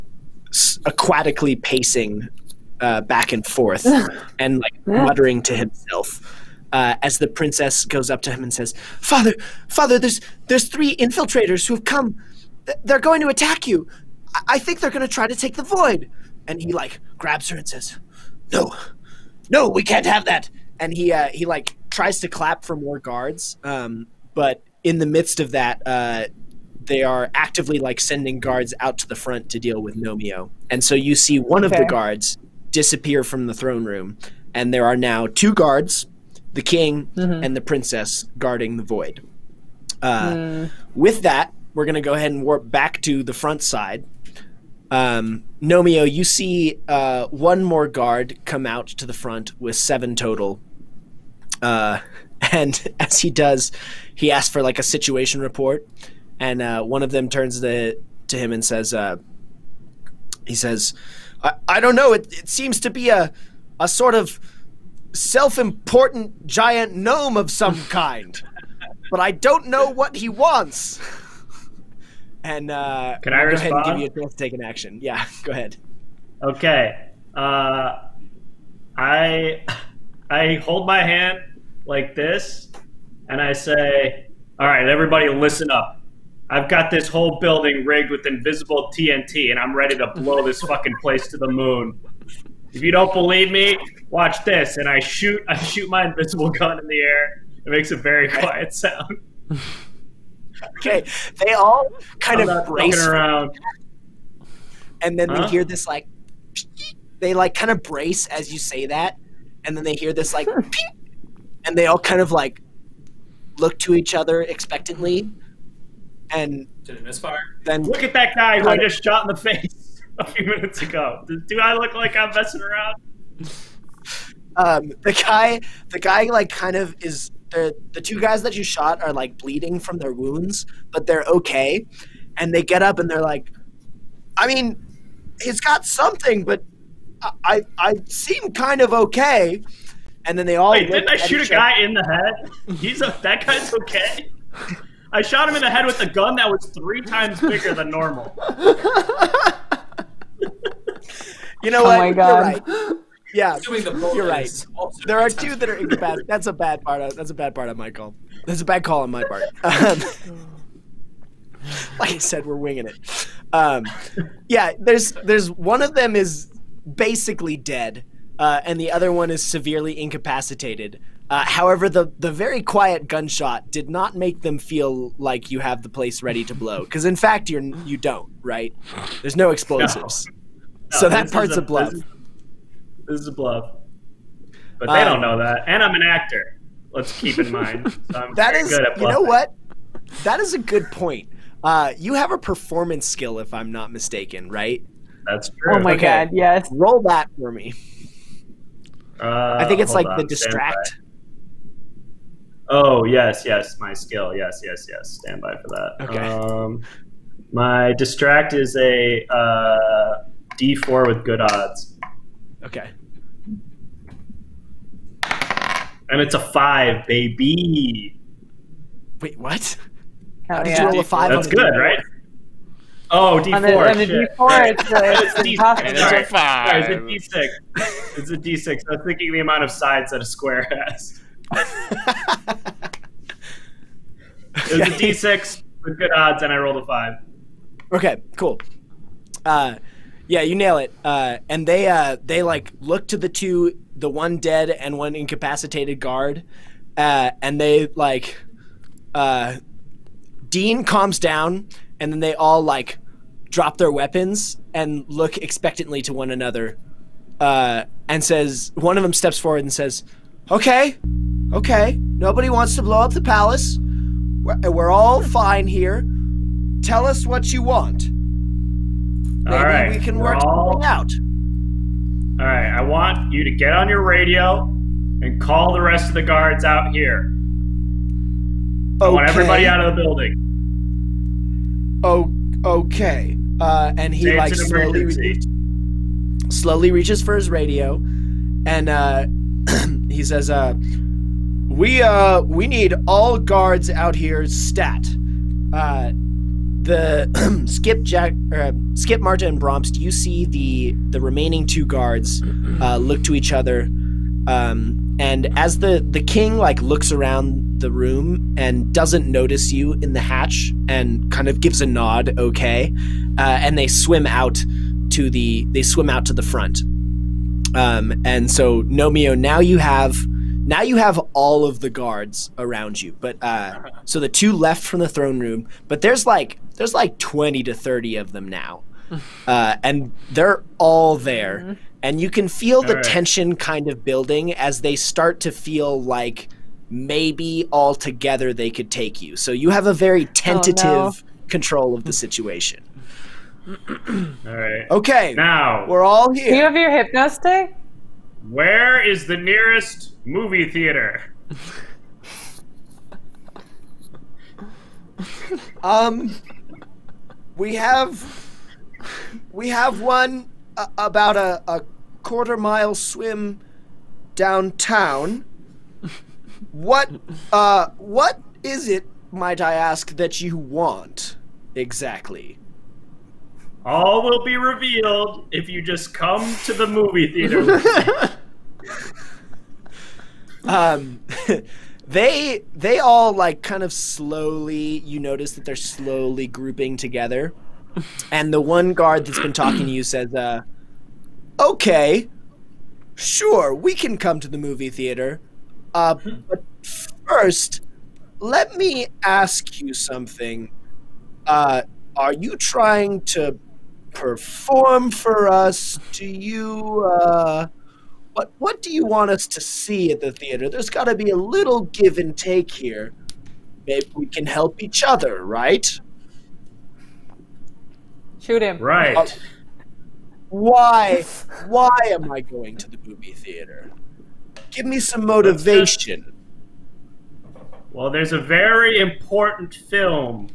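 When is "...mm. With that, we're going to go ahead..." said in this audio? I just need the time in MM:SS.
00:40.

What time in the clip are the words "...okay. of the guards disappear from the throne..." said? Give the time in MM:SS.
00:31.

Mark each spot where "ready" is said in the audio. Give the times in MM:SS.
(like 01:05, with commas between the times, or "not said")
01:29, 02:56.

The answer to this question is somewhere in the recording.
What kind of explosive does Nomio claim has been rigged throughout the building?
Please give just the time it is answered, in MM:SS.
01:28.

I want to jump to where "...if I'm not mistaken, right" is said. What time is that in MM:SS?
03:13.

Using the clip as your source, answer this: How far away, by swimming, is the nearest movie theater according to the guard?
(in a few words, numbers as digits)
a quarter mile.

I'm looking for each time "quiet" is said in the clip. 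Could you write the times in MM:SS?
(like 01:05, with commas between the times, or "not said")
01:38, 02:52.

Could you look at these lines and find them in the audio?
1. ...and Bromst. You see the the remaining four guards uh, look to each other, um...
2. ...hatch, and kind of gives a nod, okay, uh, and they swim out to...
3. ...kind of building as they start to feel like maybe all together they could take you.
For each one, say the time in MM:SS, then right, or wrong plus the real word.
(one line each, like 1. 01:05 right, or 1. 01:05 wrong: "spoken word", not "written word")
1. 04:59 wrong: "two", not "four"
2. 05:10 right
3. 05:33 right.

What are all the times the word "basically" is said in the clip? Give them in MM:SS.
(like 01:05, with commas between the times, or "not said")
02:46.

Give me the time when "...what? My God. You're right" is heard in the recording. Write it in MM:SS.
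02:31.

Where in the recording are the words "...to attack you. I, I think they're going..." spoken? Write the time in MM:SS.
00:13.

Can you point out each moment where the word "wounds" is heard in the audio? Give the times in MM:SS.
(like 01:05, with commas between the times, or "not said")
02:10.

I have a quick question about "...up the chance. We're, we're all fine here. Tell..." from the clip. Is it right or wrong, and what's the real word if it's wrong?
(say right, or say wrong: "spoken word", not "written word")
wrong: "palace", not "chance".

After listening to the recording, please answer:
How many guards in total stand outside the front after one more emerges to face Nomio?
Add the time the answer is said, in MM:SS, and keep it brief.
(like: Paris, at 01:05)
7, at 00:49.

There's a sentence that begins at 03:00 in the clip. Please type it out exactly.
No, so that part's a, a, bluff.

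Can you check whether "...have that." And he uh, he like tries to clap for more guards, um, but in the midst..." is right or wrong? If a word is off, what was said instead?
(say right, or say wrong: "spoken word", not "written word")
right.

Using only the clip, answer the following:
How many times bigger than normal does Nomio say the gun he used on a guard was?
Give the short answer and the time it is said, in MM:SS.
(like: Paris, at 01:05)
3, at 02:26.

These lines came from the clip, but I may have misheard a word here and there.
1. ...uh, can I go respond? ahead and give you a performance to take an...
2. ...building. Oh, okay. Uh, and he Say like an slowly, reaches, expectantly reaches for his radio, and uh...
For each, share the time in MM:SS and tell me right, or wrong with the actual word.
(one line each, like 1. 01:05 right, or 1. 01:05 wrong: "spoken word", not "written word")
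1. 01:12 wrong: "chance", not "performance"
2. 04:40 wrong: "slowly", not "expectantly".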